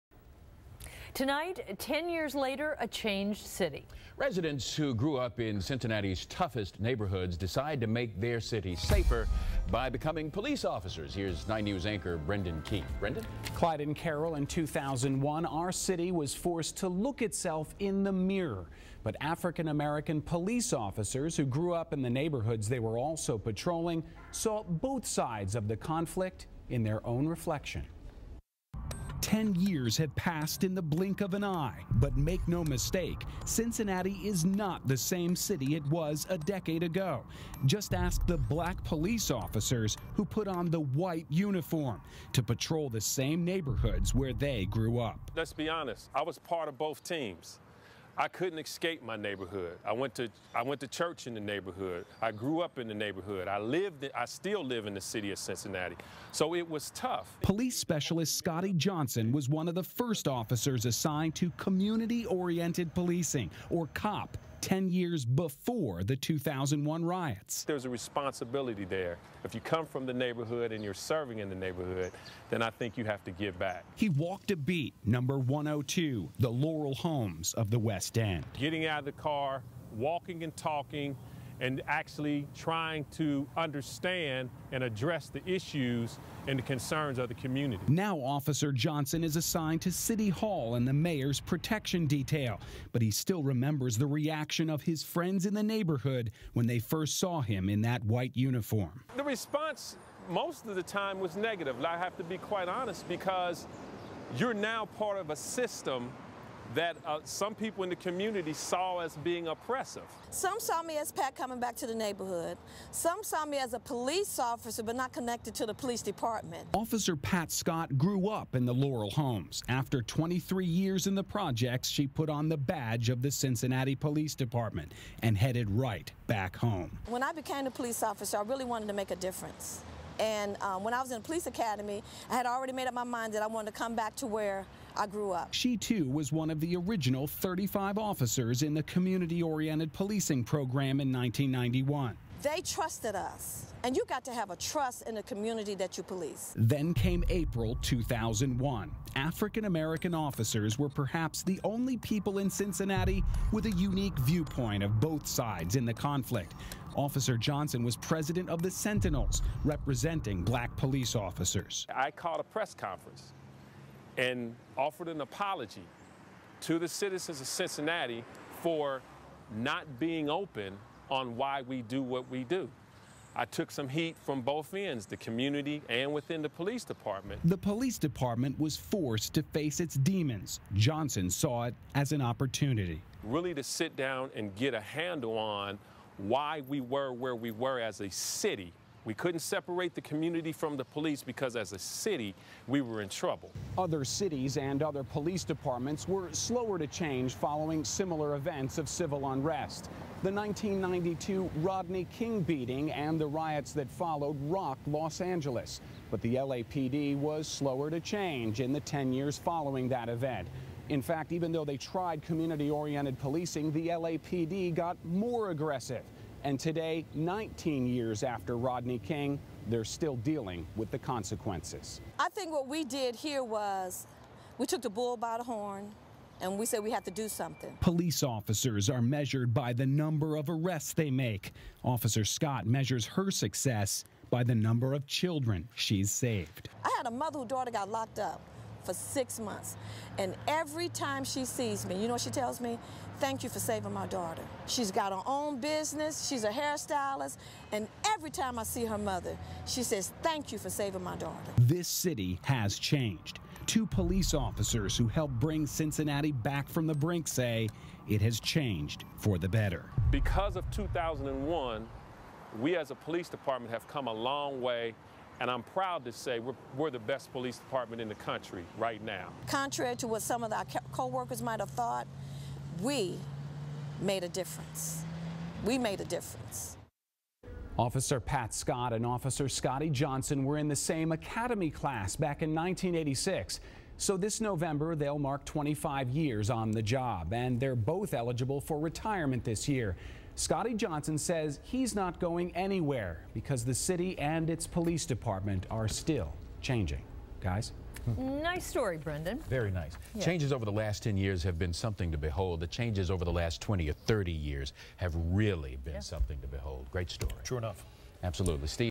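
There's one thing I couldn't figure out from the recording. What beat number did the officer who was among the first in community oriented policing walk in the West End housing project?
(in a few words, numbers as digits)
102.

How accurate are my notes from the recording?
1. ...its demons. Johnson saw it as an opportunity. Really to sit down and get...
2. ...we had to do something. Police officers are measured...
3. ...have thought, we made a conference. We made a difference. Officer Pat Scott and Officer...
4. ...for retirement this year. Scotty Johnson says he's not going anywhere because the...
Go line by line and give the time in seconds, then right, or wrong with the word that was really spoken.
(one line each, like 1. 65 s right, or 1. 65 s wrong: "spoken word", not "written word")
1. 179 s right
2. 226 s right
3. 271 s wrong: "difference", not "conference"
4. 288 s right.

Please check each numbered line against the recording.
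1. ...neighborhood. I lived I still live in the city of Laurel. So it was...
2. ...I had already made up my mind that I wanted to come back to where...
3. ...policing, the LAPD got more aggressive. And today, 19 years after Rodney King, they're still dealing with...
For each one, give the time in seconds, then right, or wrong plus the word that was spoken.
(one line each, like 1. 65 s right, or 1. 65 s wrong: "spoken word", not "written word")
1. 52 s wrong: "Cincinnati", not "Laurel"
2. 132 s right
3. 213 s right.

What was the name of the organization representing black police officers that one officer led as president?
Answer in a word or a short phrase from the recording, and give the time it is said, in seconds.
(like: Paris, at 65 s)
The Sentinels, at 158 s.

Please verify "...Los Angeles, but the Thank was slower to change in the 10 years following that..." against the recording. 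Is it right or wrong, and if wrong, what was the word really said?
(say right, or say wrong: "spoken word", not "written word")
wrong: "LAPD", not "Thank".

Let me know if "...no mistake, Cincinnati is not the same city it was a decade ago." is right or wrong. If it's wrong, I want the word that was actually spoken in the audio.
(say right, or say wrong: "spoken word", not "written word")
right.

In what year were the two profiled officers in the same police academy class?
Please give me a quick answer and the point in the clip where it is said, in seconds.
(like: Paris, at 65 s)
1986, at 282 s.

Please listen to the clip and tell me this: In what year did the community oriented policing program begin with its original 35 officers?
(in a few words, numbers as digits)
1991.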